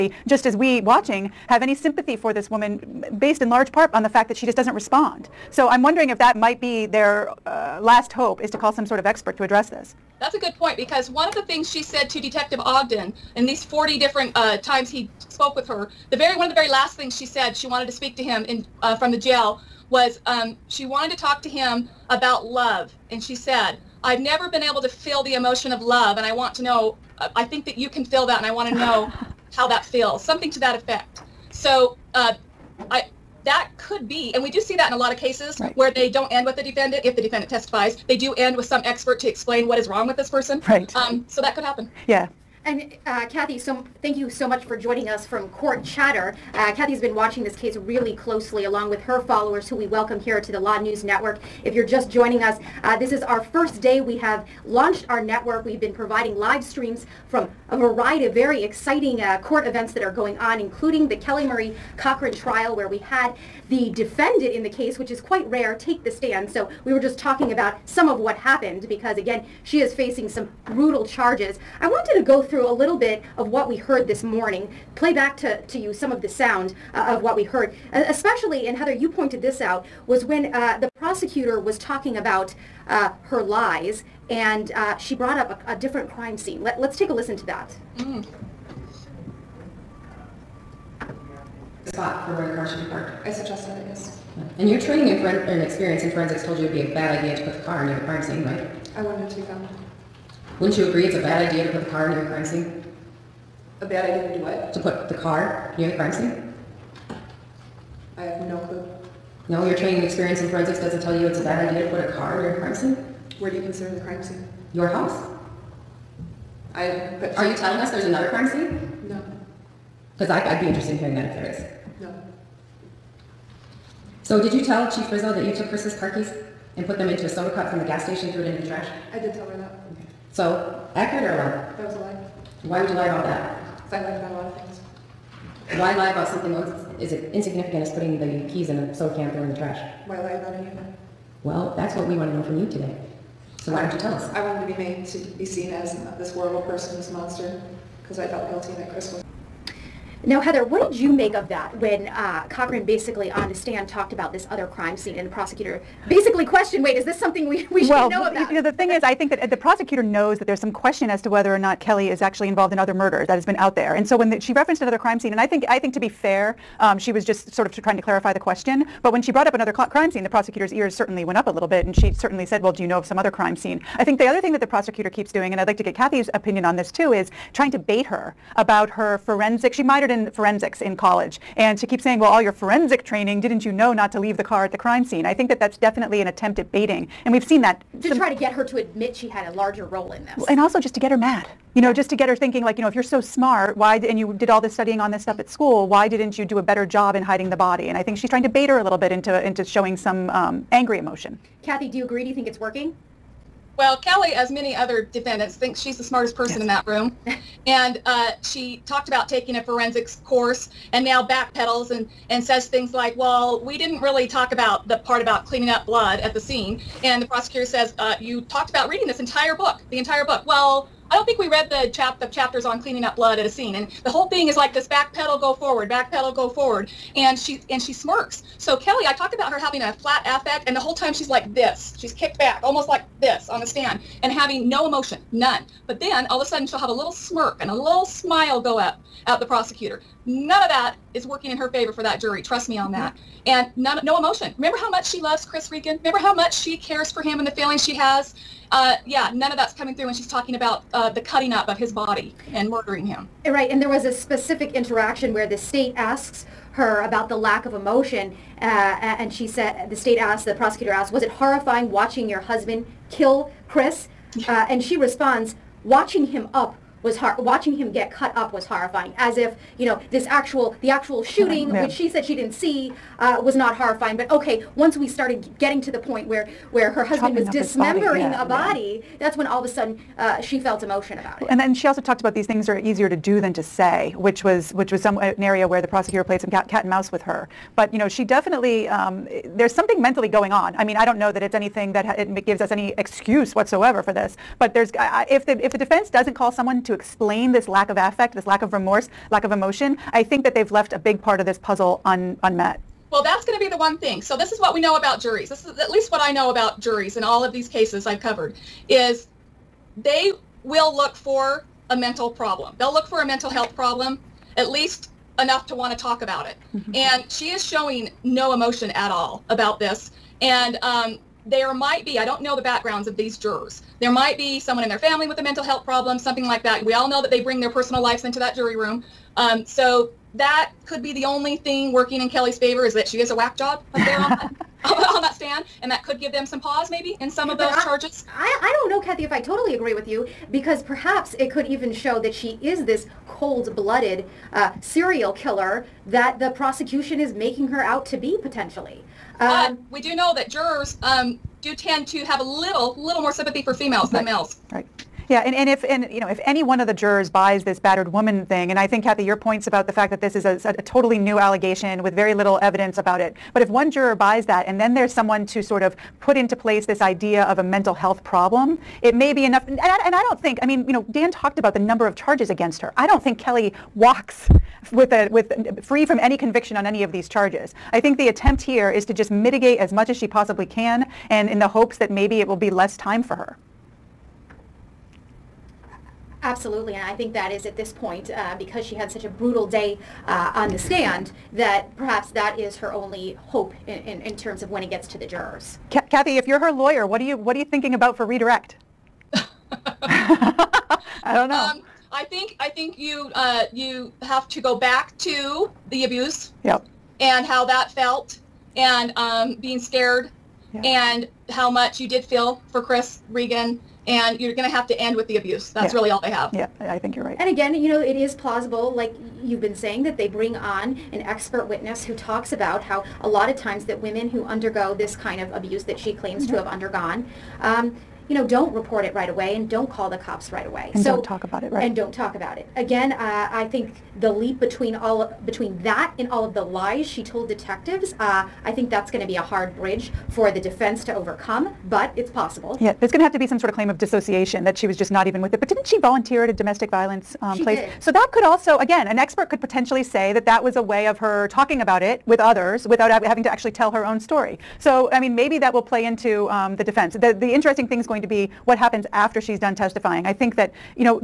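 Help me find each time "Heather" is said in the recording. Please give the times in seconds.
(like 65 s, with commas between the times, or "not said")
78 s, 150 s.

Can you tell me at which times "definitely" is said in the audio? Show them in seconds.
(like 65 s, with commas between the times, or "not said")
185 s, 288 s.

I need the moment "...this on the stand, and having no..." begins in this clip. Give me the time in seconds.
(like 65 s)
233 s.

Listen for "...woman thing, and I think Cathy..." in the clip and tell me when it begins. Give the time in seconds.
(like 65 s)
358 s.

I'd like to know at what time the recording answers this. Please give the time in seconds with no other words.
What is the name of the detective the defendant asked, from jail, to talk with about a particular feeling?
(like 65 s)
12 s.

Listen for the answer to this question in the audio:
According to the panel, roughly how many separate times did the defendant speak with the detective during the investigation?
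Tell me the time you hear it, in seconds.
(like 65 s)
13 s.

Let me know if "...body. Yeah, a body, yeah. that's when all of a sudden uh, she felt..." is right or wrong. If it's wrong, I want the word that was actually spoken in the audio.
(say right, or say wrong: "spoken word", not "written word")
right.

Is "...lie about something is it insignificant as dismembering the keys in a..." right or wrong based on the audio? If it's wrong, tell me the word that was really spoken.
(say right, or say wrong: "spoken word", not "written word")
wrong: "putting", not "dismembering".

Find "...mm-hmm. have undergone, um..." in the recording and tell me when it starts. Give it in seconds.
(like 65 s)
426 s.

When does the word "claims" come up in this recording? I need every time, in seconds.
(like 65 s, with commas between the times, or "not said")
426 s, 443 s.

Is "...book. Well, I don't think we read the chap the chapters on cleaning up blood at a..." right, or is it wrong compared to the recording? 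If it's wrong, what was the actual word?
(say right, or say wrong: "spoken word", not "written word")
right.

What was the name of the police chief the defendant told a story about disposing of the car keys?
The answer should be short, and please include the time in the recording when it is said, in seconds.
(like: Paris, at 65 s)
Chief Rizzo, at 124 s.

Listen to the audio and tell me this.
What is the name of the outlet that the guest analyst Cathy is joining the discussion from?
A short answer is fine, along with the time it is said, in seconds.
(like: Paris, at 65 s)
CourtChatter, at 45 s.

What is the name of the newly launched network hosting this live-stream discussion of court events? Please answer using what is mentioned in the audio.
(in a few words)
Law Newz Network.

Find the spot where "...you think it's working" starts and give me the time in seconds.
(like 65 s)
202 s.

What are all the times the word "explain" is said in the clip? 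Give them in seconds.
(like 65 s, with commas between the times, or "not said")
39 s, 296 s.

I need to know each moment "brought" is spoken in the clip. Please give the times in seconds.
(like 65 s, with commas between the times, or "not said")
85 s, 169 s.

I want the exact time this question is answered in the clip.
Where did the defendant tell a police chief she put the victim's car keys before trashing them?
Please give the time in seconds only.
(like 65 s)
127 s.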